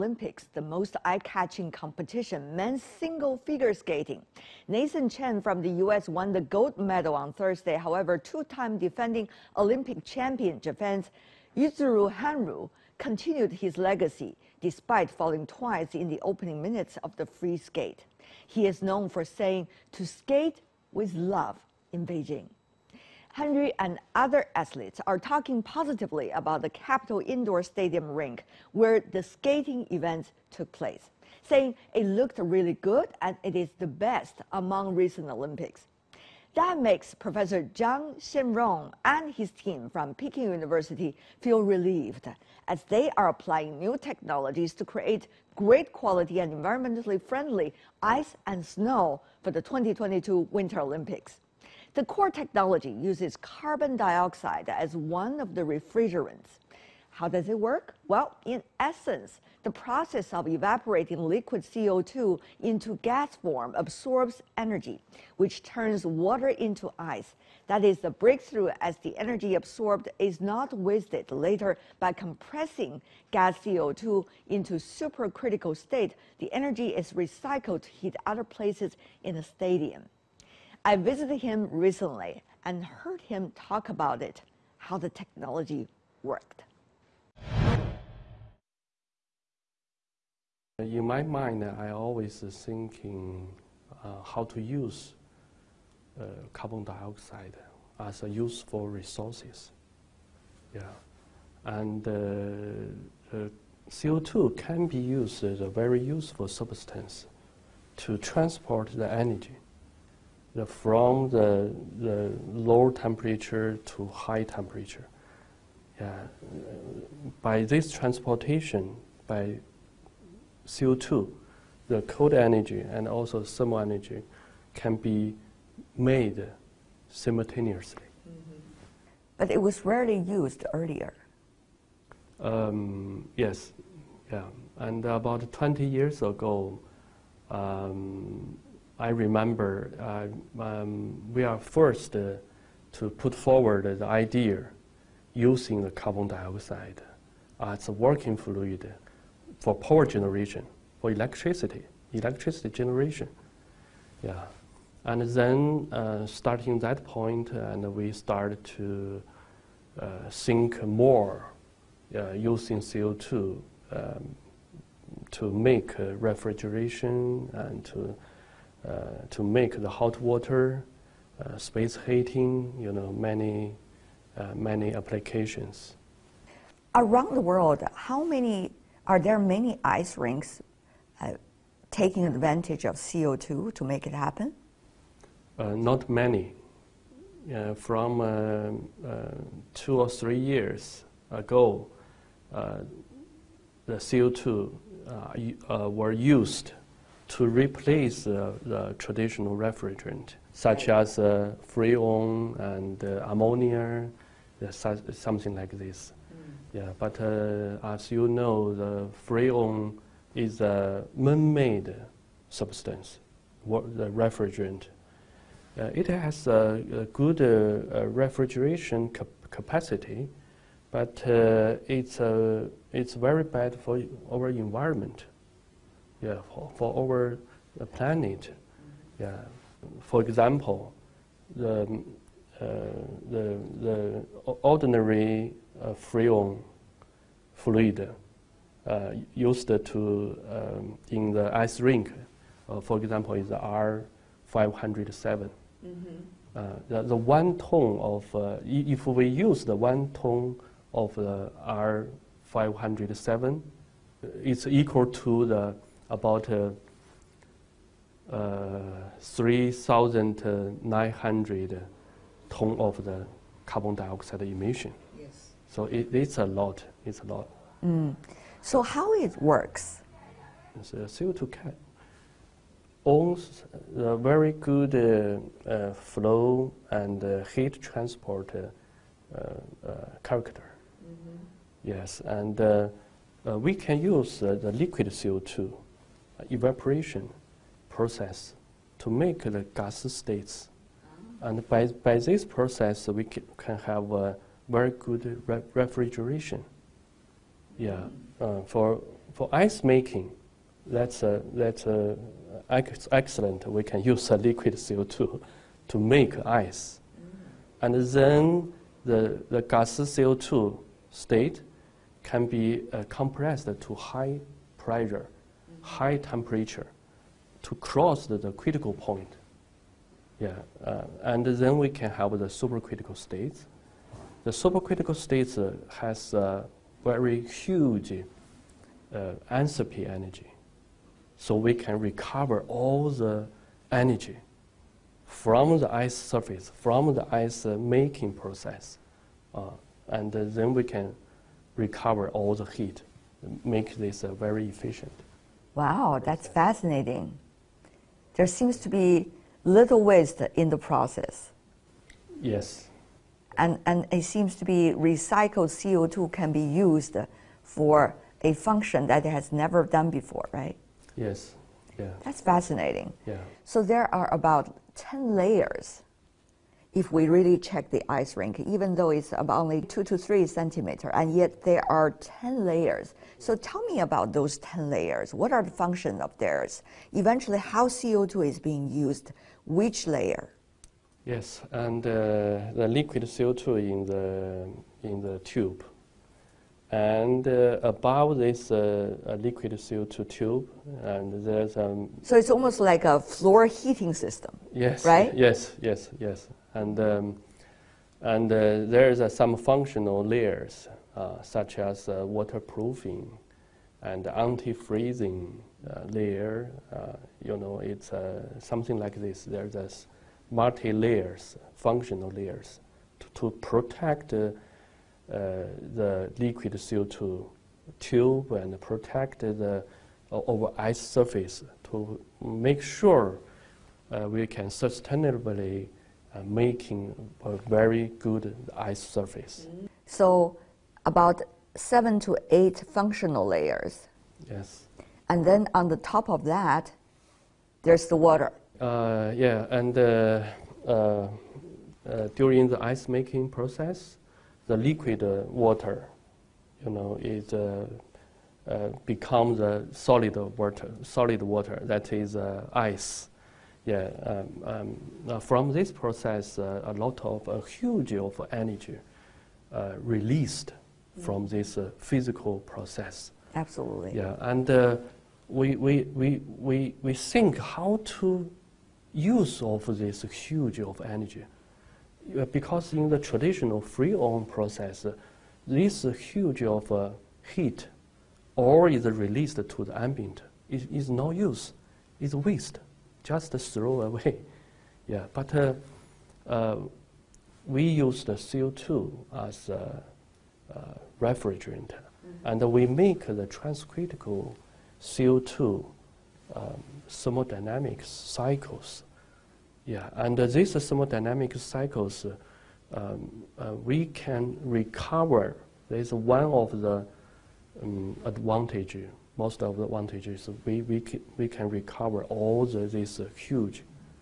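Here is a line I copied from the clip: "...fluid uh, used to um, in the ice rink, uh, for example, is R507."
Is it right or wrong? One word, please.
right.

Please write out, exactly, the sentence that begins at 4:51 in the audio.
And by, by this process, we can have a very good re refrigeration.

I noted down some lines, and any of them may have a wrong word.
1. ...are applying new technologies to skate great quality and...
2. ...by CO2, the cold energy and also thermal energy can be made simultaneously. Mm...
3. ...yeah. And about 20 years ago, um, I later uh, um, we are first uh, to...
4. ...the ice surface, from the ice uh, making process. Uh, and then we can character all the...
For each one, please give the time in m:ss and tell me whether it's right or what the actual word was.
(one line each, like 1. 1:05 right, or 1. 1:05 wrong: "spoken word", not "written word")
1. 0:43 wrong: "create", not "skate"
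2. 1:59 right
3. 2:14 wrong: "remember", not "later"
4. 5:35 wrong: "recover", not "character".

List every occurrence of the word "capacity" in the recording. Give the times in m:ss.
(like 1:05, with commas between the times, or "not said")
3:39.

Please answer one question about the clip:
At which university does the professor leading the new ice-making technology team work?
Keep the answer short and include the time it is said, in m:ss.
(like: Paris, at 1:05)
Peking University, at 0:40.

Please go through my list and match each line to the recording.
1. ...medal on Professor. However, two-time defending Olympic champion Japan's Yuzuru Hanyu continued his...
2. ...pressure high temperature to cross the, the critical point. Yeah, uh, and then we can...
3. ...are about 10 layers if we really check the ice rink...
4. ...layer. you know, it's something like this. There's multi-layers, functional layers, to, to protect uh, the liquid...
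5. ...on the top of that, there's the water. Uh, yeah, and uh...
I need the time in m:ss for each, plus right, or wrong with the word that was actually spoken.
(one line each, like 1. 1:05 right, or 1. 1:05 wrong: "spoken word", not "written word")
1. 0:06 wrong: "Thursday", not "Professor"
2. 5:14 right
3. 6:04 right
4. 6:46 right
5. 7:15 right.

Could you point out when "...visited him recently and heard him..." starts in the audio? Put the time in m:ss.
1:20.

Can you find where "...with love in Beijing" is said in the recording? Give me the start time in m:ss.
0:20.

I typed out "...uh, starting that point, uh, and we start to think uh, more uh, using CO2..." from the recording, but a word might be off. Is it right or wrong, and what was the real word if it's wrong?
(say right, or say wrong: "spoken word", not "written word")
right.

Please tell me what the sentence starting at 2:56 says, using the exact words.
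Around the world, how many, are there many ice rinks taking advantage of CO2 to make it happen?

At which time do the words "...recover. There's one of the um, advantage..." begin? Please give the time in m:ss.
8:24.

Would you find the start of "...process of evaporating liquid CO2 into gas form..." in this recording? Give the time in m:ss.
0:59.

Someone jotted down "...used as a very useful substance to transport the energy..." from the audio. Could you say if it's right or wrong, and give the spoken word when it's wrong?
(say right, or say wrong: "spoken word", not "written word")
right.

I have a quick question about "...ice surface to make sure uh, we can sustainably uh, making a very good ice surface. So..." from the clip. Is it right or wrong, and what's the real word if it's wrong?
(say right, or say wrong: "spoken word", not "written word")
right.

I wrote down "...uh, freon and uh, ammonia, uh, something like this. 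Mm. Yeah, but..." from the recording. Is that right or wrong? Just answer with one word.
right.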